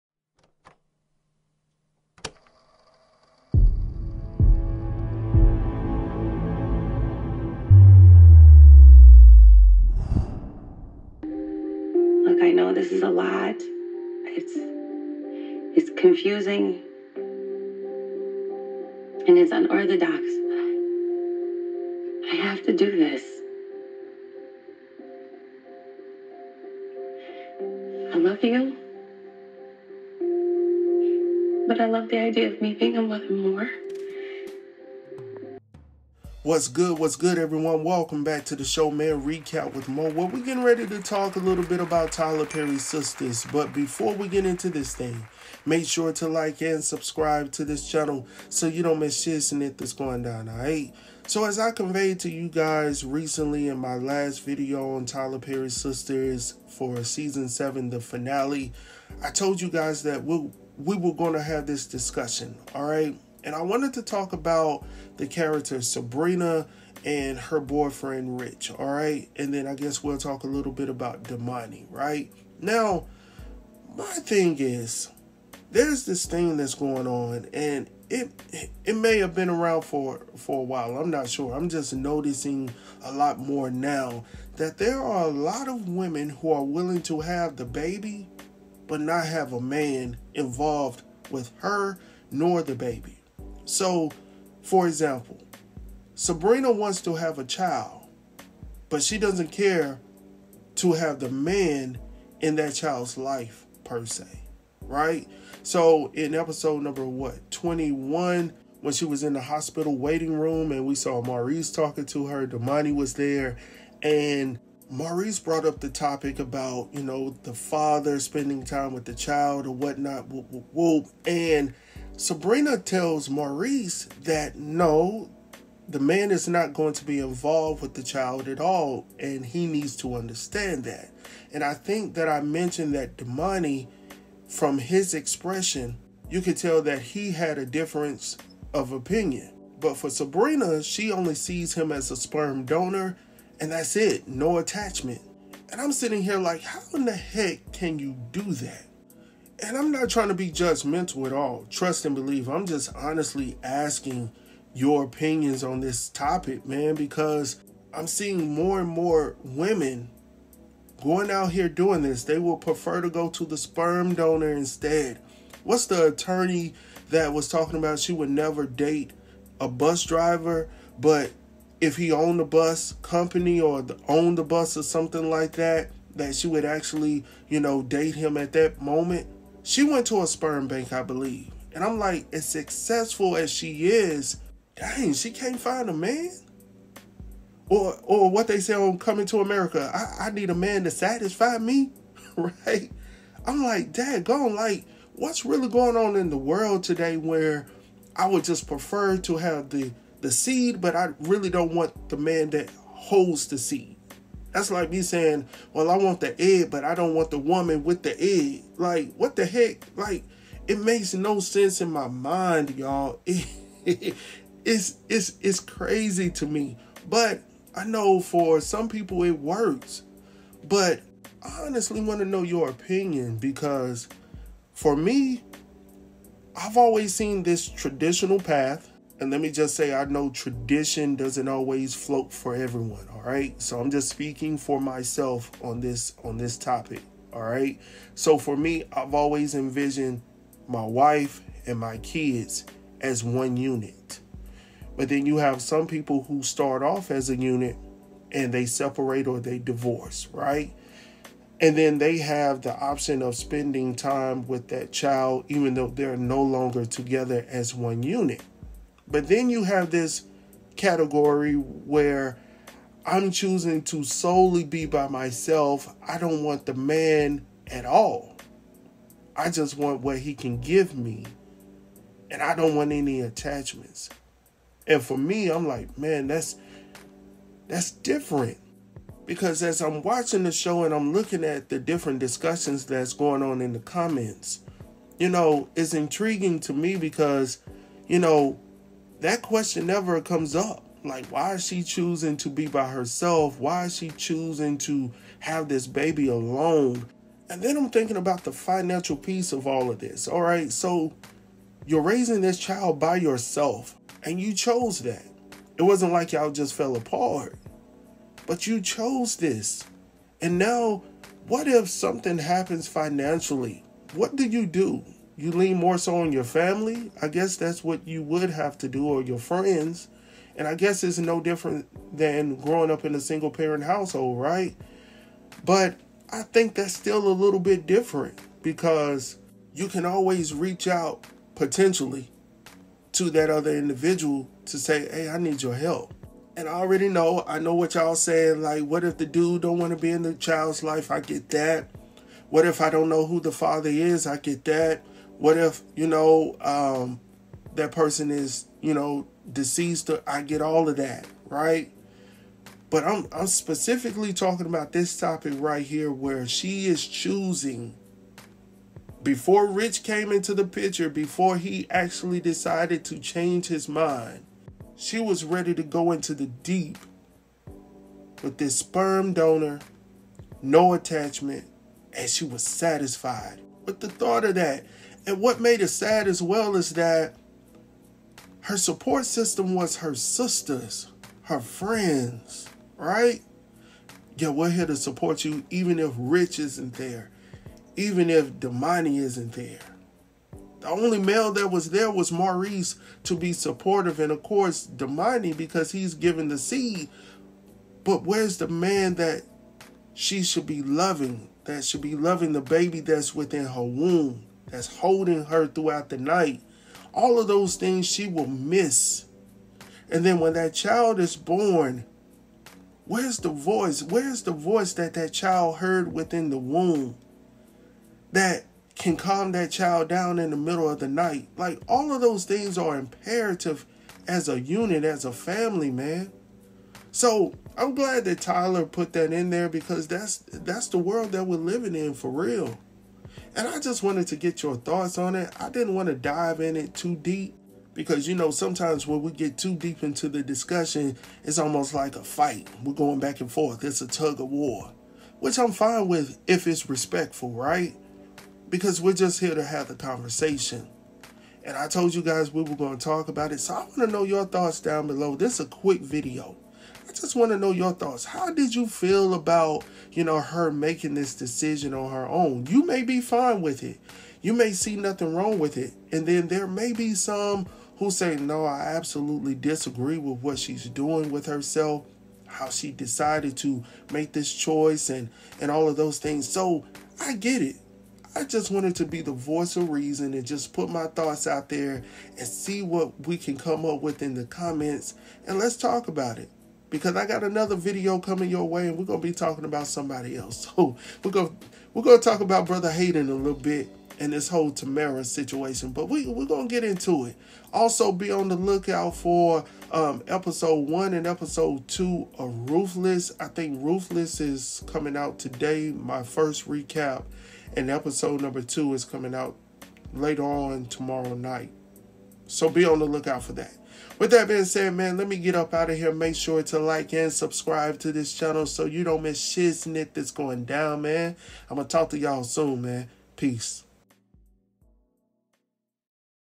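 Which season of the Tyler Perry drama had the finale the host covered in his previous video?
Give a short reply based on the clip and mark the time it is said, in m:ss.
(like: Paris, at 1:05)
7, at 0:57.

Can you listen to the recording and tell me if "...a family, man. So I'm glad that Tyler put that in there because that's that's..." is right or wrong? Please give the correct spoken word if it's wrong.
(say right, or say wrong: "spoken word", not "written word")
right.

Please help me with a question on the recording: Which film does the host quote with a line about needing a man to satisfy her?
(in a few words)
Coming to America.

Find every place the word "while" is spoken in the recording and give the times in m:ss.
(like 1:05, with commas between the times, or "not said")
1:20.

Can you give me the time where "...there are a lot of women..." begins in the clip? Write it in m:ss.
1:24.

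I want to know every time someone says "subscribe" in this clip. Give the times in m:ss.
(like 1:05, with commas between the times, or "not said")
0:46, 8:37.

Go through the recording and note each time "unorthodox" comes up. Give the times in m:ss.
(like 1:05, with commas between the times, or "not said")
0:19.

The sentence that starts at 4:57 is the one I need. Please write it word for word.
And then I'm thinking about the financial piece of all of this.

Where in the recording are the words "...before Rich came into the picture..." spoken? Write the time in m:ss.
5:59.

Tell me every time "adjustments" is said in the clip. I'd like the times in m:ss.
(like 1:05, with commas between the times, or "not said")
not said.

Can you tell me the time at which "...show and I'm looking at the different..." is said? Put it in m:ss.
4:40.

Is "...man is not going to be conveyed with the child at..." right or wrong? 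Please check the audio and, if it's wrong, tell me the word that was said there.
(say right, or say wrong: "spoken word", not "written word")
wrong: "involved", not "conveyed".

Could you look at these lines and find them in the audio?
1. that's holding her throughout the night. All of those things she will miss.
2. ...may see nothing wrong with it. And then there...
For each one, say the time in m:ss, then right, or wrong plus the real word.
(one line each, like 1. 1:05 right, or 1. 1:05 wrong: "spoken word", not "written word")
1. 6:44 right
2. 7:44 right.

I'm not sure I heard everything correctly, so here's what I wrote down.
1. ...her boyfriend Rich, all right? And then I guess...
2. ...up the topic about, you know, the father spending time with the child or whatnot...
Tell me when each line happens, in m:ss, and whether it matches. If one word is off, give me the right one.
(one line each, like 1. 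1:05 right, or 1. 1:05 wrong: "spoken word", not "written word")
1. 1:07 right
2. 1:55 right.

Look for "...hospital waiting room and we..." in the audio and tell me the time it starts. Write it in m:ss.
1:49.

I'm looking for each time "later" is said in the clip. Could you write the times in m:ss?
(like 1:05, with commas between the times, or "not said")
8:30.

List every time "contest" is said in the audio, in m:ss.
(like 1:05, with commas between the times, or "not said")
not said.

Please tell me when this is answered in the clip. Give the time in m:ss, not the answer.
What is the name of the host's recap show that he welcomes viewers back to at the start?
0:39.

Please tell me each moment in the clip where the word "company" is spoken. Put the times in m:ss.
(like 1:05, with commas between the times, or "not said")
2:53.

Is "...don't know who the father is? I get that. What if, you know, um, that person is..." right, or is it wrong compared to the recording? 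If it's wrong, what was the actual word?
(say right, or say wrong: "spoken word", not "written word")
right.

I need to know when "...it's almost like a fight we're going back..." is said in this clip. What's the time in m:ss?
7:21.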